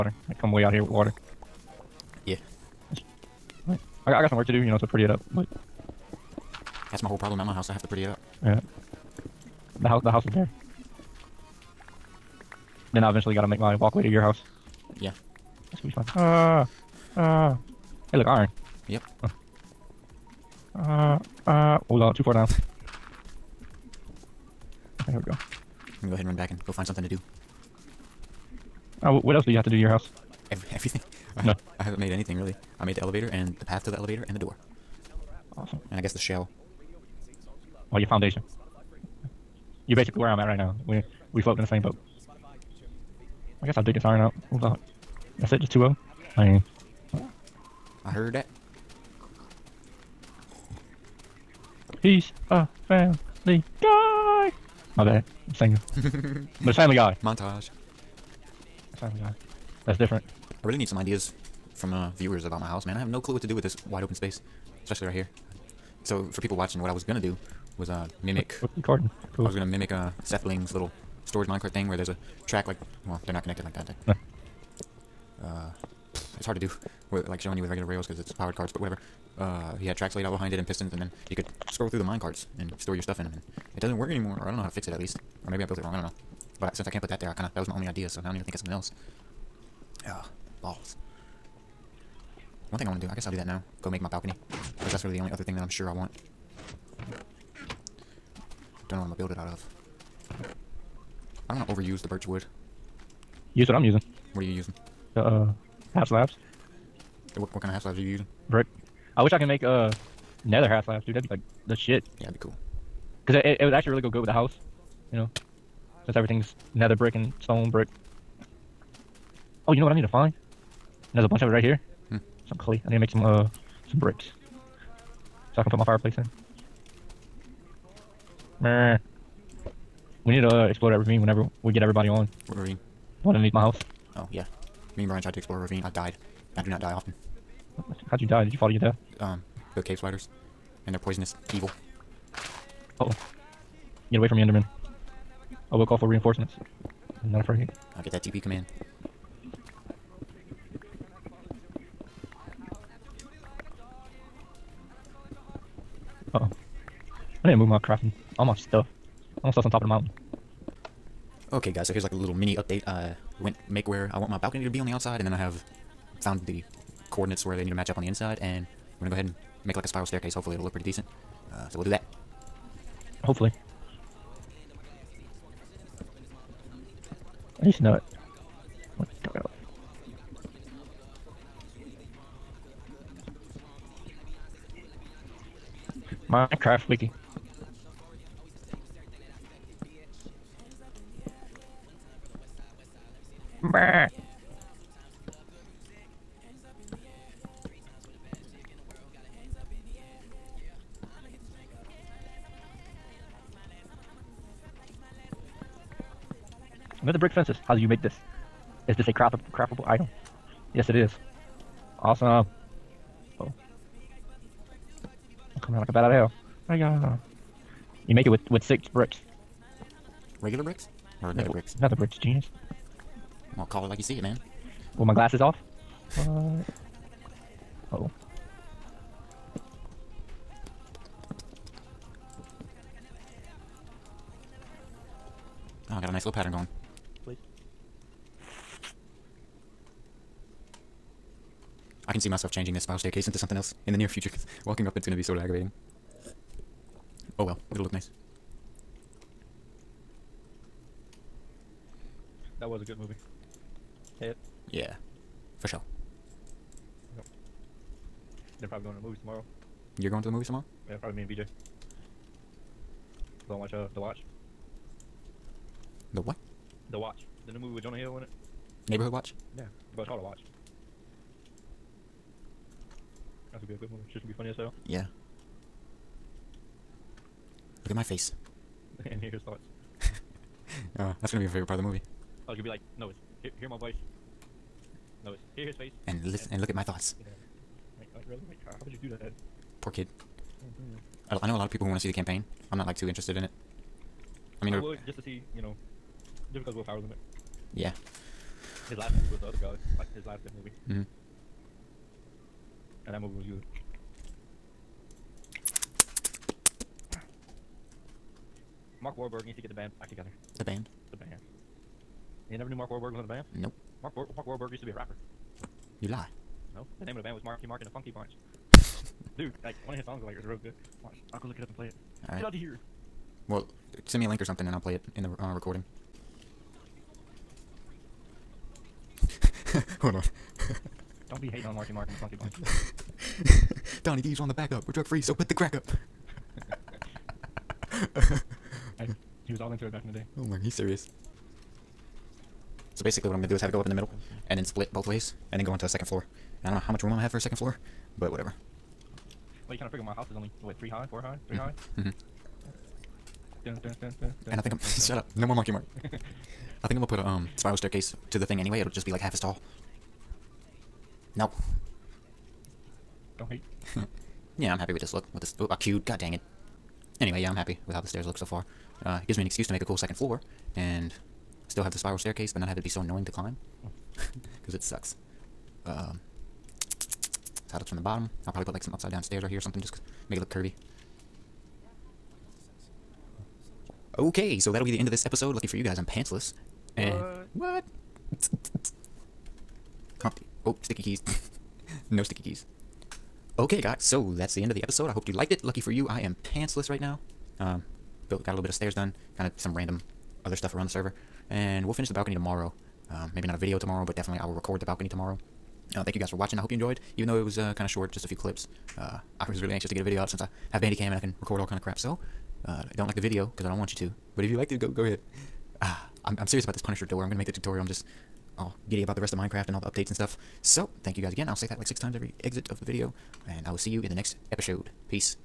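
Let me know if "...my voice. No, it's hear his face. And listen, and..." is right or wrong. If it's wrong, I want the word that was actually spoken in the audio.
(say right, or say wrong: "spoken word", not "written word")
right.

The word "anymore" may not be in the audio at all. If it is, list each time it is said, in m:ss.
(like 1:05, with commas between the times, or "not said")
1:24.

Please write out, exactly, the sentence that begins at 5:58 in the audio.
It'll just be like half as tall.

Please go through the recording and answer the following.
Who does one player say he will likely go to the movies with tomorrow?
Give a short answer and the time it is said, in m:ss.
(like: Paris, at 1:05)
BJ, at 4:21.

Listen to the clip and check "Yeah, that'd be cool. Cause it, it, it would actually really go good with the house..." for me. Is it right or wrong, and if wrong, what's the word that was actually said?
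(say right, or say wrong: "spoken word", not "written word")
right.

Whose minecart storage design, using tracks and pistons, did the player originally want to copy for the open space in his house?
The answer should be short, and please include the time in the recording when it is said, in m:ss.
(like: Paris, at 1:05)
SethBling, at 1:10.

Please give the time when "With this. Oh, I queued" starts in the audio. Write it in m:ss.
6:05.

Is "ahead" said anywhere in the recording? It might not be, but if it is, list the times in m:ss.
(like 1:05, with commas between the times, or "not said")
0:26, 2:49, 6:55.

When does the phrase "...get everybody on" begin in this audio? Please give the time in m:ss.
2:11.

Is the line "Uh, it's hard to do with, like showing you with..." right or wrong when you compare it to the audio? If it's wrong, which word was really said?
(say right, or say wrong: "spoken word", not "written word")
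right.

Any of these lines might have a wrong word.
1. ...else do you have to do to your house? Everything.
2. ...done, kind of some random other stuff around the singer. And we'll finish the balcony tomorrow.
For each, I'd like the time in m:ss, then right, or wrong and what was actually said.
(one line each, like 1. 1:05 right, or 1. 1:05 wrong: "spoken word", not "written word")
1. 0:29 right
2. 6:38 wrong: "server", not "singer".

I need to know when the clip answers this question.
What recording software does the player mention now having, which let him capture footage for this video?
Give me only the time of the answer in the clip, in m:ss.
6:50.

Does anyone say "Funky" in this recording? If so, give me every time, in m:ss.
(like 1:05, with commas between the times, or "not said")
5:17, 5:32.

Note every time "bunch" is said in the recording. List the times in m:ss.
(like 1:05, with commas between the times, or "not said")
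2:01, 5:18, 5:32.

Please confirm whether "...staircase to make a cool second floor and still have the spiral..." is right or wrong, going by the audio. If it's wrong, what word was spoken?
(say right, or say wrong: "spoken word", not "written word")
wrong: "excuse", not "staircase".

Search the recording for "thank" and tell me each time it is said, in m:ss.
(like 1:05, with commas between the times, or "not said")
6:46, 7:01.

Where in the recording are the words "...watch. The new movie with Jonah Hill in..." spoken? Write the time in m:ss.
4:26.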